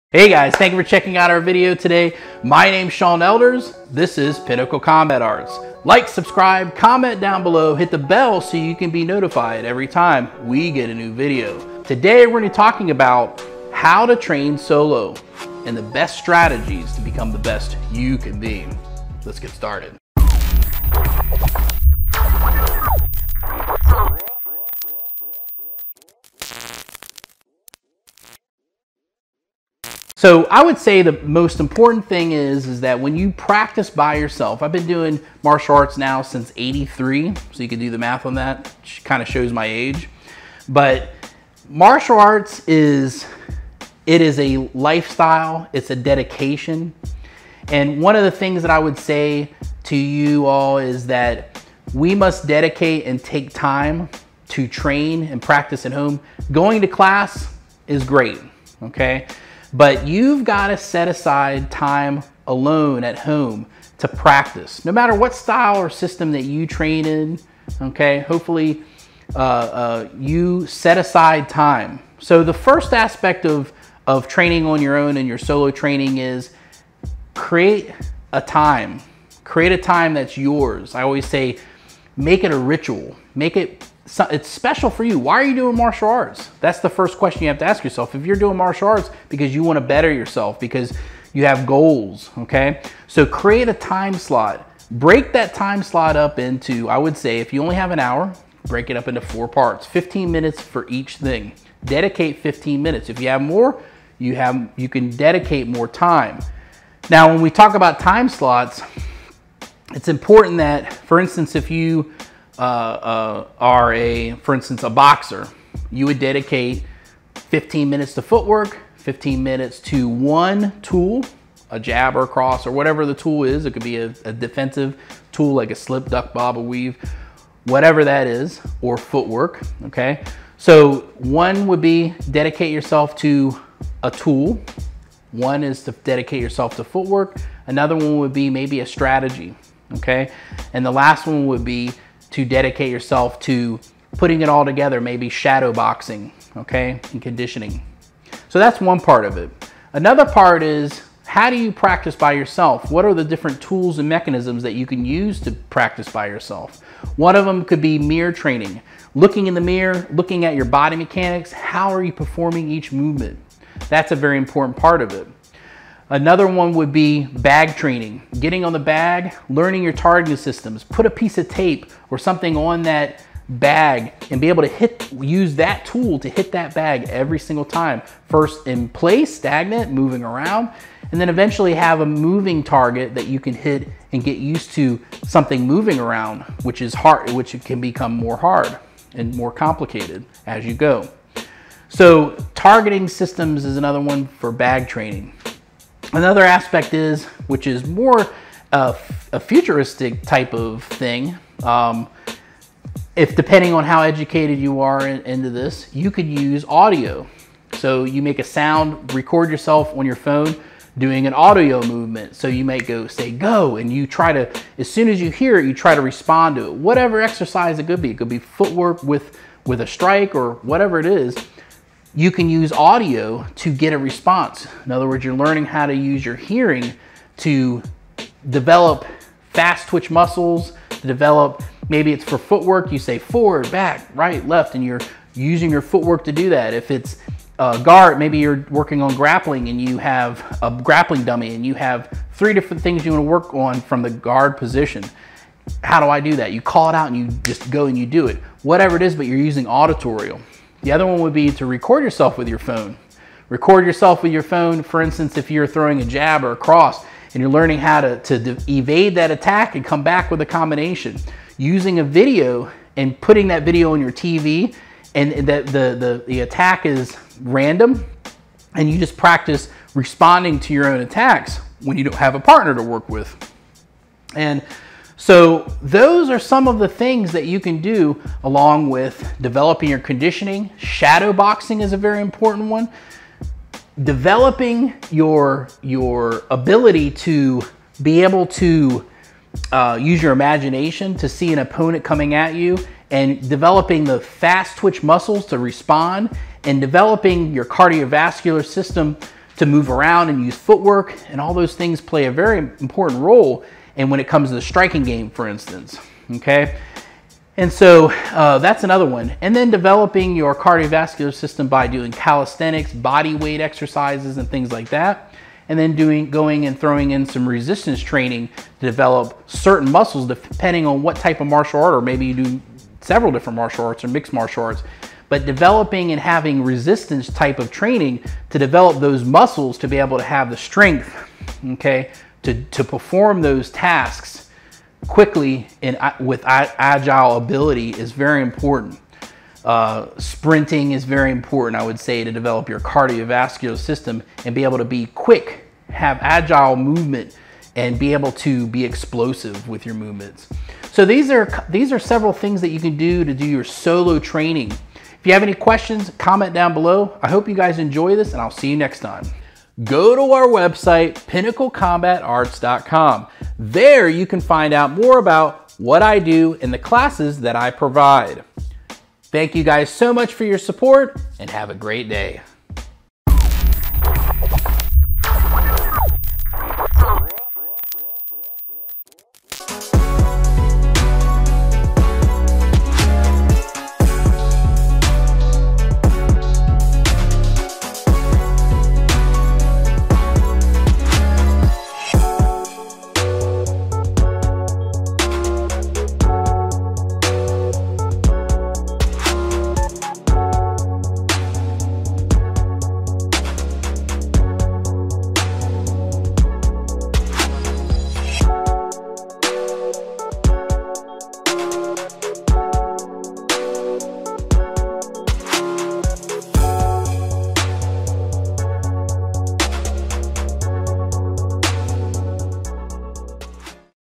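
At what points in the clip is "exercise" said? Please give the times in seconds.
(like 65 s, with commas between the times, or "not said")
217 s, 313 s.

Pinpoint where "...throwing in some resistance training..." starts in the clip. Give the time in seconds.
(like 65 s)
316 s.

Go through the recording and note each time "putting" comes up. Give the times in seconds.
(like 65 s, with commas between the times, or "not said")
144 s, 263 s.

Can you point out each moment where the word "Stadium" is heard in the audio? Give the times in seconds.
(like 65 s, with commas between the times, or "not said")
not said.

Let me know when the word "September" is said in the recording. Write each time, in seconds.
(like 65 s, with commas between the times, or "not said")
not said.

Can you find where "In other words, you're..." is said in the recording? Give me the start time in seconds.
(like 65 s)
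224 s.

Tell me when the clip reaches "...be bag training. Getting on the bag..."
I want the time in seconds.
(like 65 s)
166 s.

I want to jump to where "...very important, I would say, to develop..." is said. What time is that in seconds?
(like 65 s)
341 s.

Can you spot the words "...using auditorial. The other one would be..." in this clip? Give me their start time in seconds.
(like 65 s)
249 s.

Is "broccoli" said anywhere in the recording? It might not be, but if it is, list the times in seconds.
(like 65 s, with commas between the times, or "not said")
not said.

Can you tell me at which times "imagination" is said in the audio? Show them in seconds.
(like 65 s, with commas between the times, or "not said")
290 s.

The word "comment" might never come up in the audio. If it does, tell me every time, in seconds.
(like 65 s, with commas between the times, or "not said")
6 s, 356 s.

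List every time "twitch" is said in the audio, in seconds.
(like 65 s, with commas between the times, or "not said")
229 s, 294 s.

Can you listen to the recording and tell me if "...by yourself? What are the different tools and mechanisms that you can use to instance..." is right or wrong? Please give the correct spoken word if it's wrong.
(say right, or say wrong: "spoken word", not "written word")
wrong: "practice", not "instance".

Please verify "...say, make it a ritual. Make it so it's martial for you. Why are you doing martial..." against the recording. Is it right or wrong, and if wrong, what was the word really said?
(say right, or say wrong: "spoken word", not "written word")
wrong: "special", not "martial".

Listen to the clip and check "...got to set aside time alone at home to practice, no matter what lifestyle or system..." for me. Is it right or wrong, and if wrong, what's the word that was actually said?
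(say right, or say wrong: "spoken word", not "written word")
wrong: "style", not "lifestyle".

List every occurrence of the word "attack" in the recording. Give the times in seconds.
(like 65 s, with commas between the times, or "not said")
259 s, 266 s, 271 s.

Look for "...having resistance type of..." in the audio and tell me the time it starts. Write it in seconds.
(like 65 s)
326 s.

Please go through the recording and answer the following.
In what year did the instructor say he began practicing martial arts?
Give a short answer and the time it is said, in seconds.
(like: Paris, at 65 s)
1983, at 36 s.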